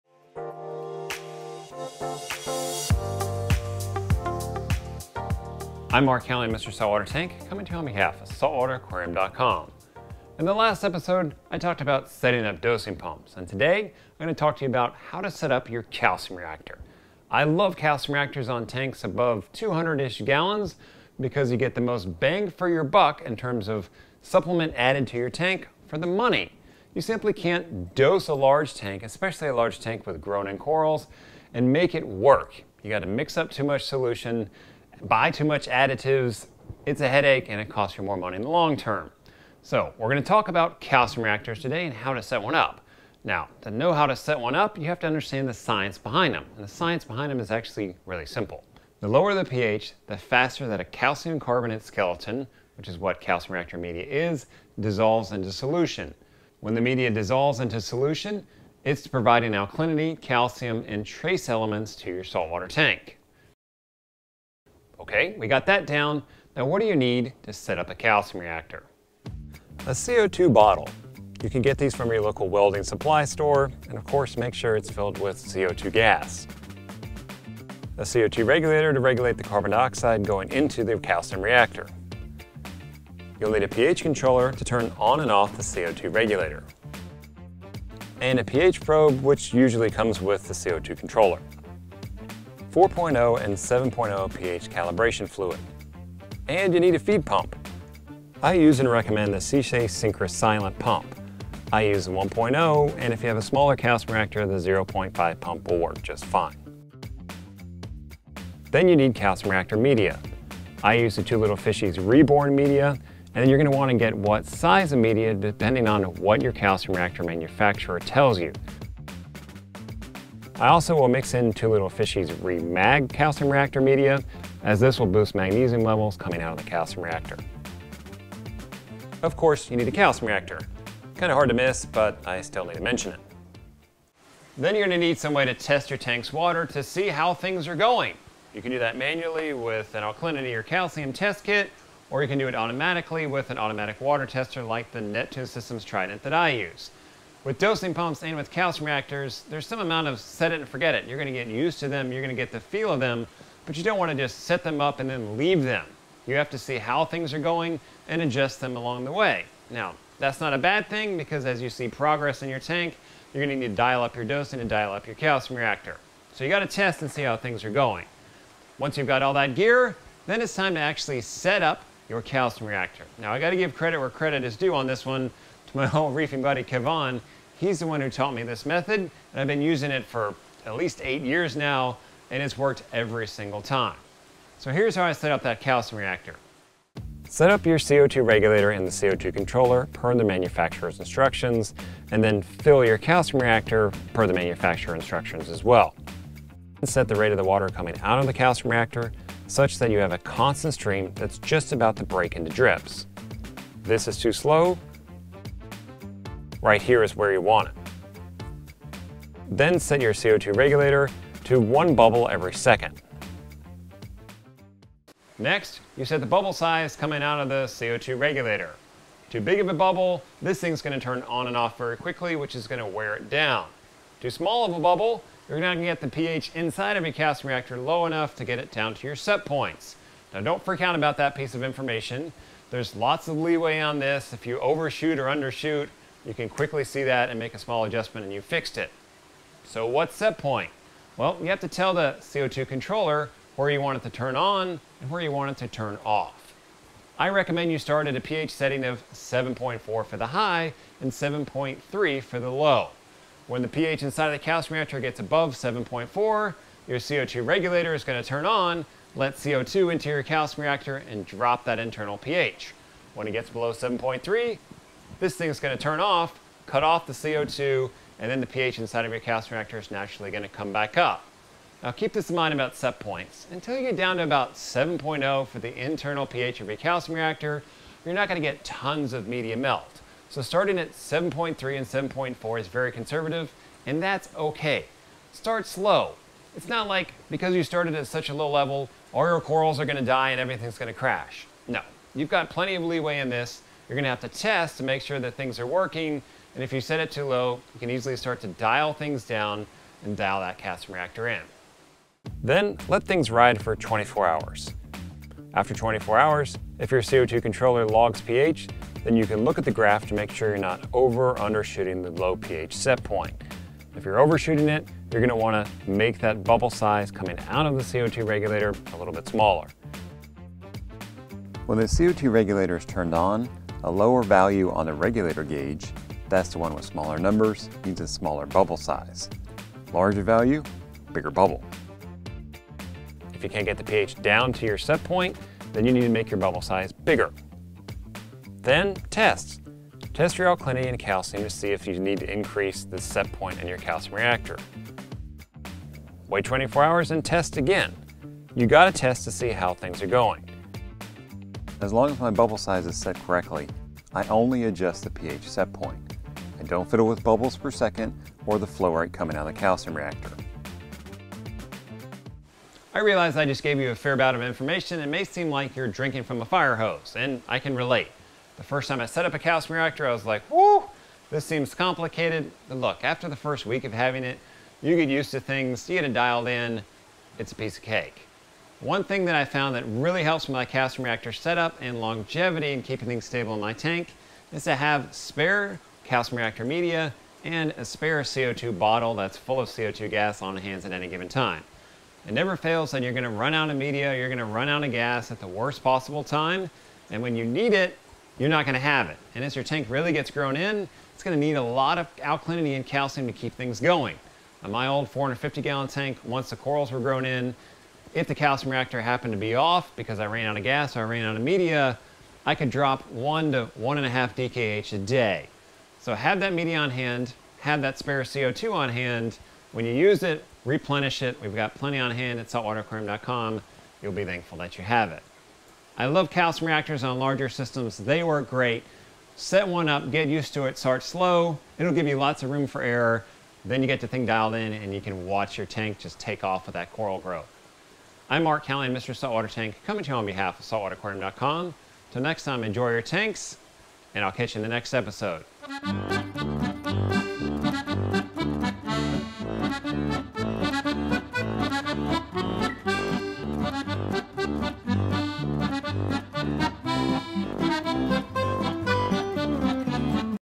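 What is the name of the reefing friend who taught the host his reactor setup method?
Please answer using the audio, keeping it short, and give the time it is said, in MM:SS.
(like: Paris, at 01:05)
Kevon, at 02:56.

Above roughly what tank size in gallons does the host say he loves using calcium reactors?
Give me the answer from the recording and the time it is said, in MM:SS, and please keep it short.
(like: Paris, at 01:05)
200, at 00:19.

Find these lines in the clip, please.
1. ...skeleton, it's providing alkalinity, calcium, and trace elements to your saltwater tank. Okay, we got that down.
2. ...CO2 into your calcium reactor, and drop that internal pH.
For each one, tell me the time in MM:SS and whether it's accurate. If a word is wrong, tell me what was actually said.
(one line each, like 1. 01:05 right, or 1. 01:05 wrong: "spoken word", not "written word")
1. 00:57 wrong: "solution", not "skeleton"
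2. 04:19 right.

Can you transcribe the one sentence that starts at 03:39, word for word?
Too big of a bubble, this thing's going to turn on and off very quickly, which is going to wear it down.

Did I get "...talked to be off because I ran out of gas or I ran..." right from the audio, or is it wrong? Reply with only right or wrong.
wrong.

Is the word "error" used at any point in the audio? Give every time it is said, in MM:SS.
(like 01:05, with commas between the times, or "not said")
07:12.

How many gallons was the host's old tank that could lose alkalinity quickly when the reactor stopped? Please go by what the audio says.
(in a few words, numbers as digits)
450.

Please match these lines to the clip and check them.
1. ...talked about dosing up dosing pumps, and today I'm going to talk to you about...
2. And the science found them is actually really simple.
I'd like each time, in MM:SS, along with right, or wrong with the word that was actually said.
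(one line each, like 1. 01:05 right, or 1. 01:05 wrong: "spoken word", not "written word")
1. 00:11 wrong: "setting", not "dosing"
2. 00:46 wrong: "behind", not "found".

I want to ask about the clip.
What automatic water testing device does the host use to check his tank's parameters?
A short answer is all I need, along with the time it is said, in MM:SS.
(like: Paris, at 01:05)
Neptune Systems Trident, at 02:25.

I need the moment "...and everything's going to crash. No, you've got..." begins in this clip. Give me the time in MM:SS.
04:50.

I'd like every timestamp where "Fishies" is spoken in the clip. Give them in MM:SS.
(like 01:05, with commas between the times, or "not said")
01:51, 02:01.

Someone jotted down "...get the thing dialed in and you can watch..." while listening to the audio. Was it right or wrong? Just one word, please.
right.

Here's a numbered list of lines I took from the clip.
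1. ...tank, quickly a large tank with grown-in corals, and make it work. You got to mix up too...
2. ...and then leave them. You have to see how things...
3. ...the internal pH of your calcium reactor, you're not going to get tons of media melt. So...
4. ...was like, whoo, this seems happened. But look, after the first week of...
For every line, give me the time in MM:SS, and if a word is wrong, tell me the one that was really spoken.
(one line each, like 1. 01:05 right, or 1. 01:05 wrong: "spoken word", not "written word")
1. 00:28 wrong: "especially", not "quickly"
2. 02:34 right
3. 04:35 right
4. 06:10 wrong: "complicated", not "happened".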